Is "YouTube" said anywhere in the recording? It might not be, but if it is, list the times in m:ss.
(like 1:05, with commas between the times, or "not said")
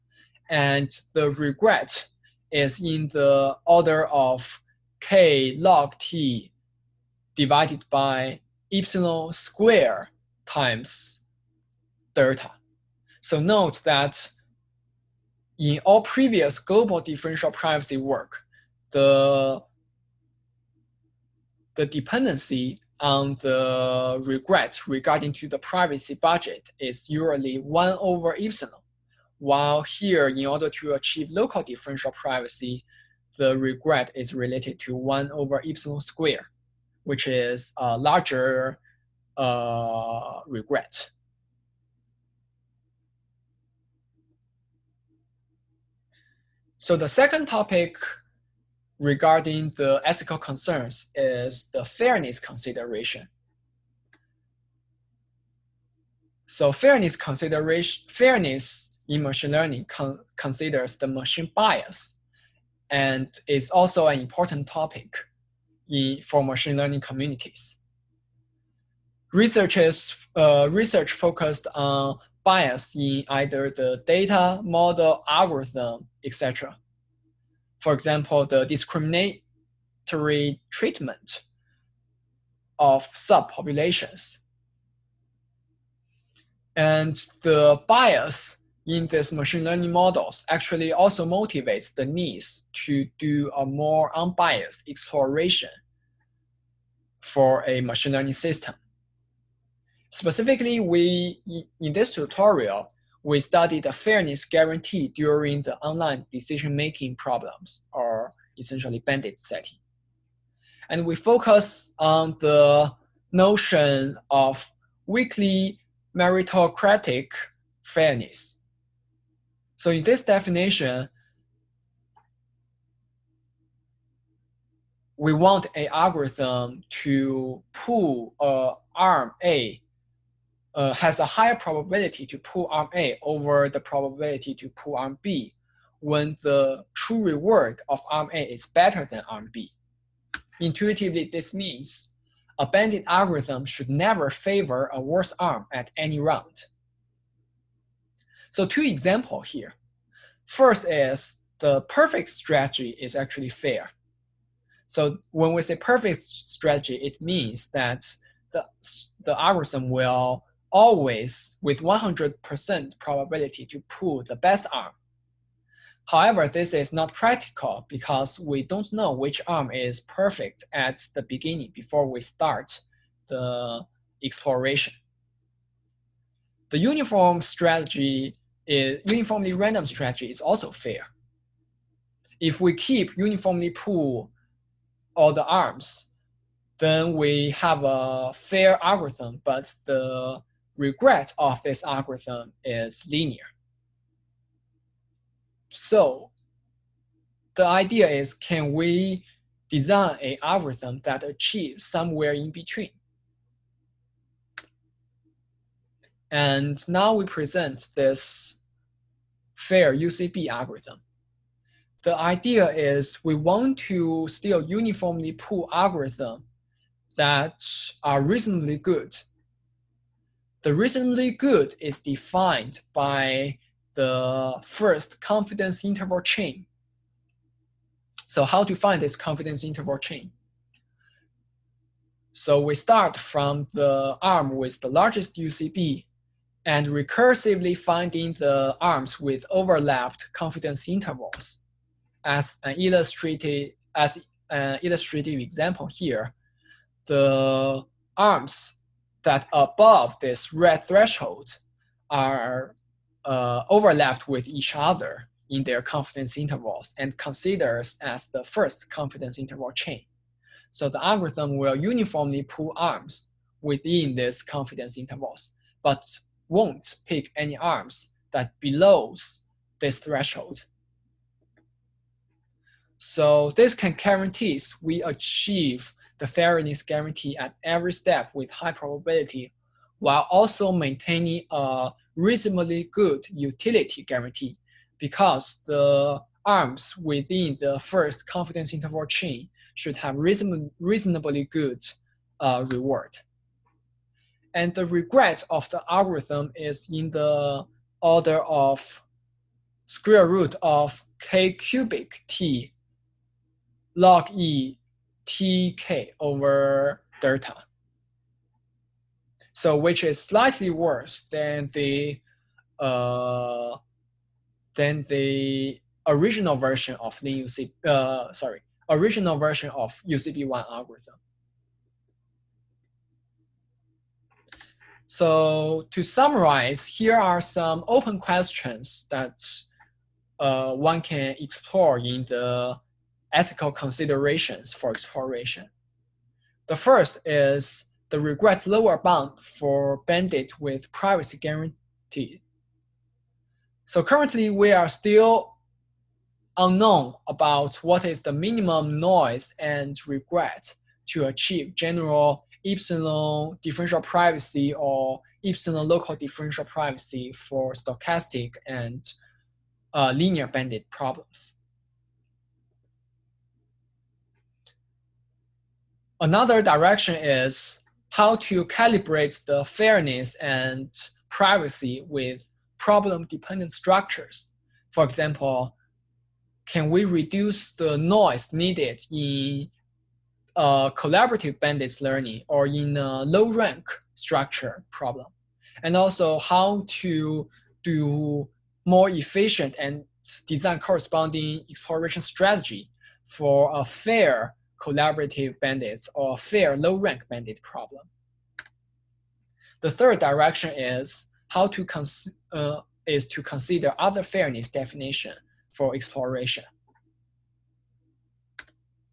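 not said.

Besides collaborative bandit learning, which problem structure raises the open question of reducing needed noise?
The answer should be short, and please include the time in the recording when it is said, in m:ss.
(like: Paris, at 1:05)
low rank structure, at 6:23.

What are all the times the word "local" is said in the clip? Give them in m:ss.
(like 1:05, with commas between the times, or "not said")
0:31, 5:55.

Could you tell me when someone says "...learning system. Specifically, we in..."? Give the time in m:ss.
1:38.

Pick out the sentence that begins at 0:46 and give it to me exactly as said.
So the second topic regarding the ethical concerns is the fairness consideration.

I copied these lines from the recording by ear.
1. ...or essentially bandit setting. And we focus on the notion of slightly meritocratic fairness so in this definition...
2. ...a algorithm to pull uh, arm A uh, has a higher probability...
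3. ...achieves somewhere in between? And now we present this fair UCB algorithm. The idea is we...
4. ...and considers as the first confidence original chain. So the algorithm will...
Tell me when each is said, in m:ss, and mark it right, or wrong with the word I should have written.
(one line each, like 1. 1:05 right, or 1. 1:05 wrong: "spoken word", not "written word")
1. 1:47 wrong: "weakly", not "slightly"
2. 2:05 right
3. 3:21 right
4. 4:16 wrong: "interval", not "original".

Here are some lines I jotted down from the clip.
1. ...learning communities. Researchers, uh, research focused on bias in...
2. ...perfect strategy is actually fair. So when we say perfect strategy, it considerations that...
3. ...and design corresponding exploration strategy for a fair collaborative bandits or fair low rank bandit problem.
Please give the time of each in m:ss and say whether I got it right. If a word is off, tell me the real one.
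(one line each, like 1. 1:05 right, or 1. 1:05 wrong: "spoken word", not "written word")
1. 1:06 right
2. 2:31 wrong: "means", not "considerations"
3. 6:29 right.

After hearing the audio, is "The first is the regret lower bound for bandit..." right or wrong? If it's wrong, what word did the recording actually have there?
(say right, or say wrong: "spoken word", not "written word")
right.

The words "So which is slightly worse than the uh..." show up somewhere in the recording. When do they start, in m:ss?
5:09.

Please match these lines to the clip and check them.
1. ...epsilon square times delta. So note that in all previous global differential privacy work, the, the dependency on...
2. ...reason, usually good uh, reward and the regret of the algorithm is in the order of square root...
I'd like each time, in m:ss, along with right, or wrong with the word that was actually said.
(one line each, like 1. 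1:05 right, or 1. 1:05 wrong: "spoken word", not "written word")
1. 0:08 right
2. 4:50 wrong: "reasonably", not "usually".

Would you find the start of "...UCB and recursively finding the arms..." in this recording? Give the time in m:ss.
3:55.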